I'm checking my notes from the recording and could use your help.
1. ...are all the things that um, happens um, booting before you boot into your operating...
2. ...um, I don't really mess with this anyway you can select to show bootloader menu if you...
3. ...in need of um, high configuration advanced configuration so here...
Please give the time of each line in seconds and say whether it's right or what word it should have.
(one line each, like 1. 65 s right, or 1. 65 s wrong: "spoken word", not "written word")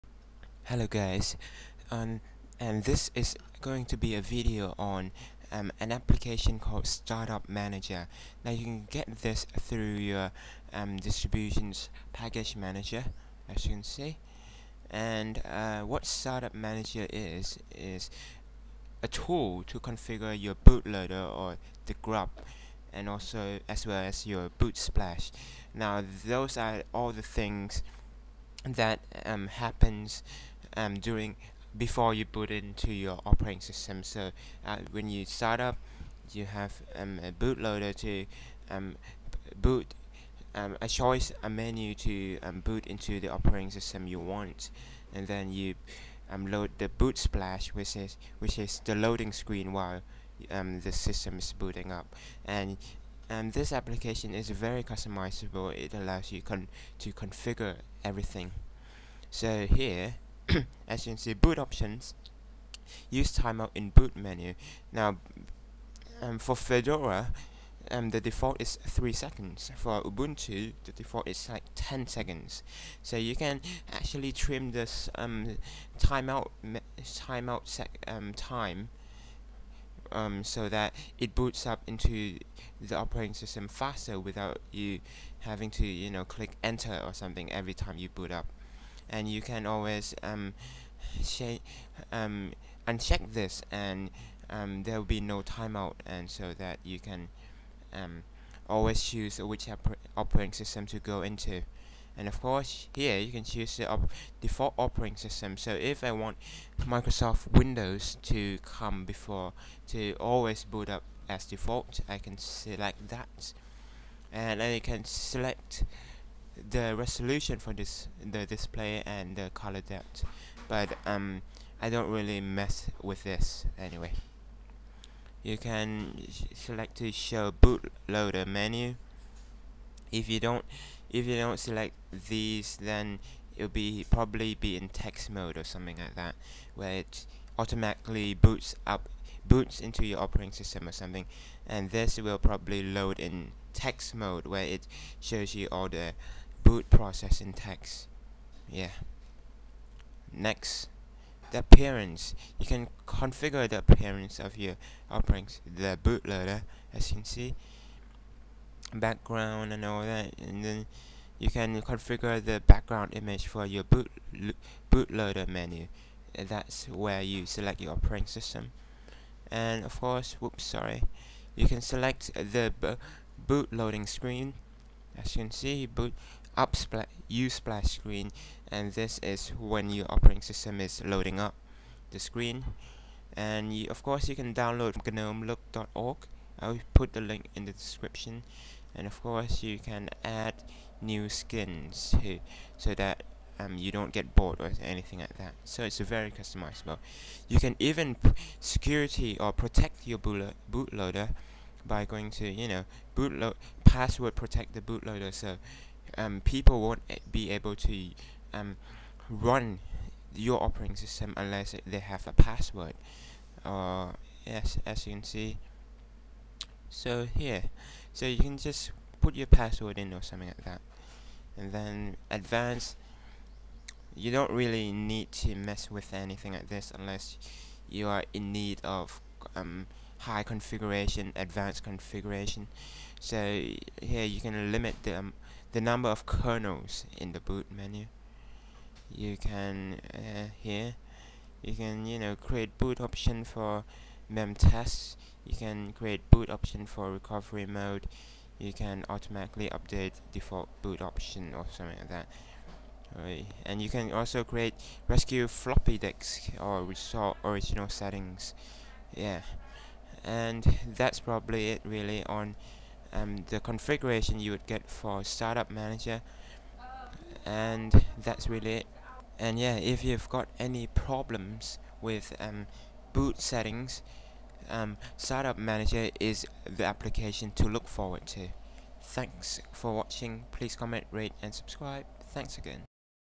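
1. 26 s wrong: "during", not "booting"
2. 121 s right
3. 228 s right.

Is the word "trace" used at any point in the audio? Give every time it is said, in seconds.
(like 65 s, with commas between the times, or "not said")
not said.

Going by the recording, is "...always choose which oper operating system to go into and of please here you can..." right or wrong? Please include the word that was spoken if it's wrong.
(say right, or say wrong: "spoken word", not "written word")
wrong: "course", not "please".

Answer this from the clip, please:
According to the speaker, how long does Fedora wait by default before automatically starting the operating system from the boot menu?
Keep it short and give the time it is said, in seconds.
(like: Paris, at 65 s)
3 seconds, at 68 s.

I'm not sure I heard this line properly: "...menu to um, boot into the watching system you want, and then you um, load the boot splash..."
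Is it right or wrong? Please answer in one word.
wrong.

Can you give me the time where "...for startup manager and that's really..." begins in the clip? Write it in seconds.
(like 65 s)
264 s.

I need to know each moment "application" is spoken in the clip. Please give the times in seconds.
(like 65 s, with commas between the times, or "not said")
5 s, 53 s, 276 s.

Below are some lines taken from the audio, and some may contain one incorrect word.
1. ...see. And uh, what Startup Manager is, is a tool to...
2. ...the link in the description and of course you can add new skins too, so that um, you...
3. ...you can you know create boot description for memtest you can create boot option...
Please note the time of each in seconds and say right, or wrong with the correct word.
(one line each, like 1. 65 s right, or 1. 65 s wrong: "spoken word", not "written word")
1. 13 s right
2. 187 s right
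3. 241 s wrong: "option", not "description".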